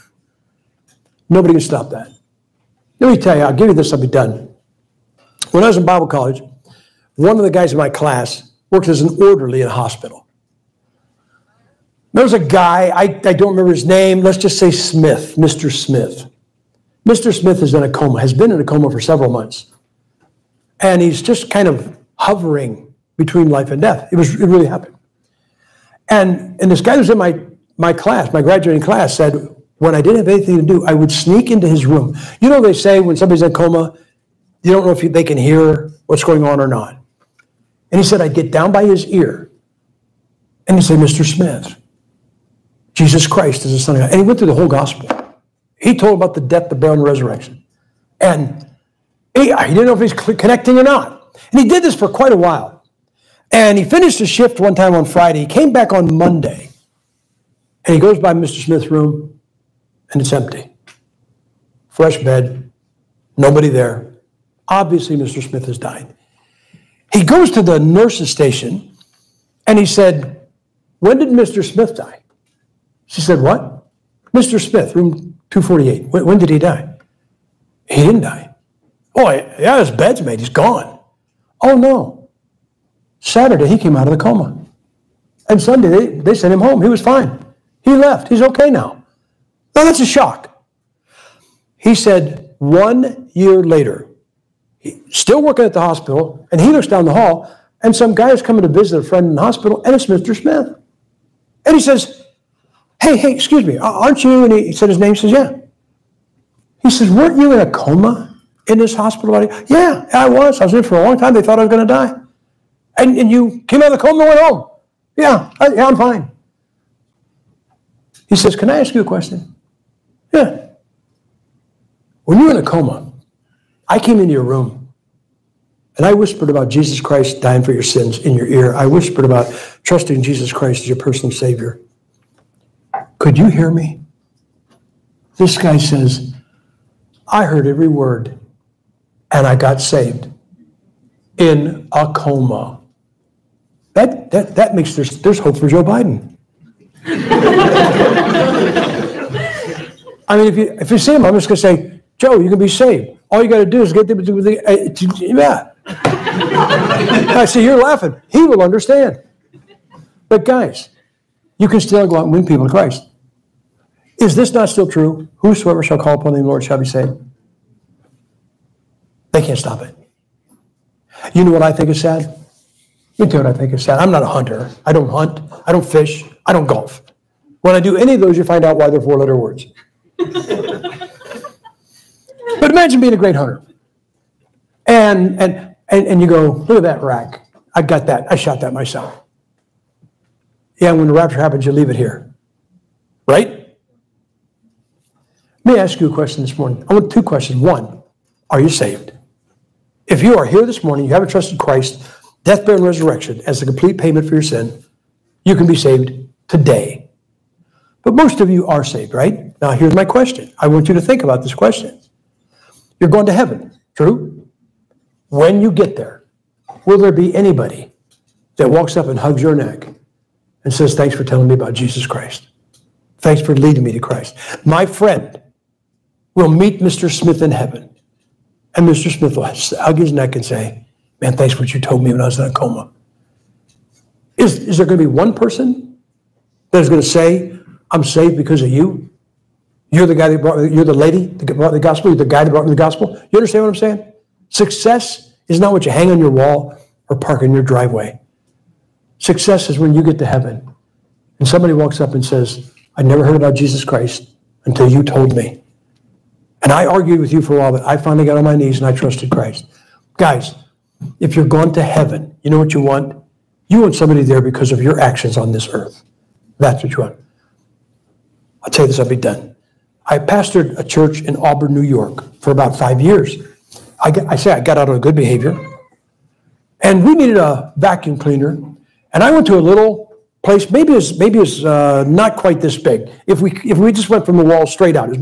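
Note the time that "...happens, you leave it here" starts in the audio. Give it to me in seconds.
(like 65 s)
191 s.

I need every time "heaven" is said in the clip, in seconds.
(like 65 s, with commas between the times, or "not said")
213 s, 227 s, 250 s, 261 s.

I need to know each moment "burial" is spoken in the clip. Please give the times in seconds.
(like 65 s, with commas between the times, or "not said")
46 s, 202 s.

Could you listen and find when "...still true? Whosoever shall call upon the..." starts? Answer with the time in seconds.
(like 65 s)
164 s.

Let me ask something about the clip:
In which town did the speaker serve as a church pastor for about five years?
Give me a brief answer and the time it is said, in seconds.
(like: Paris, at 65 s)
Auburn, New York, at 271 s.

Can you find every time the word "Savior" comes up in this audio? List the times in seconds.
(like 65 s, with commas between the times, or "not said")
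131 s.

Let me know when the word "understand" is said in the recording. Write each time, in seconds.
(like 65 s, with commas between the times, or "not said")
158 s, 243 s.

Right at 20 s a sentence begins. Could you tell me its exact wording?
And he's just kind of hovering between life and death.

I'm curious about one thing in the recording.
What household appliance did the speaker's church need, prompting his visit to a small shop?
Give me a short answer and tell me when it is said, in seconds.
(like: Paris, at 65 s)
vacuum cleaner, at 277 s.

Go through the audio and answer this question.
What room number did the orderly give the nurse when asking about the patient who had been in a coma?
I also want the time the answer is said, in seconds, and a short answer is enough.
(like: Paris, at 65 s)
248, at 74 s.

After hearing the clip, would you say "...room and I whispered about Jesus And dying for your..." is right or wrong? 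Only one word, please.
wrong.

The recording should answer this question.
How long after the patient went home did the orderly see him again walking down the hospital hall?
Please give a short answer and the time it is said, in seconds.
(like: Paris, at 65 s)
one year later, at 92 s.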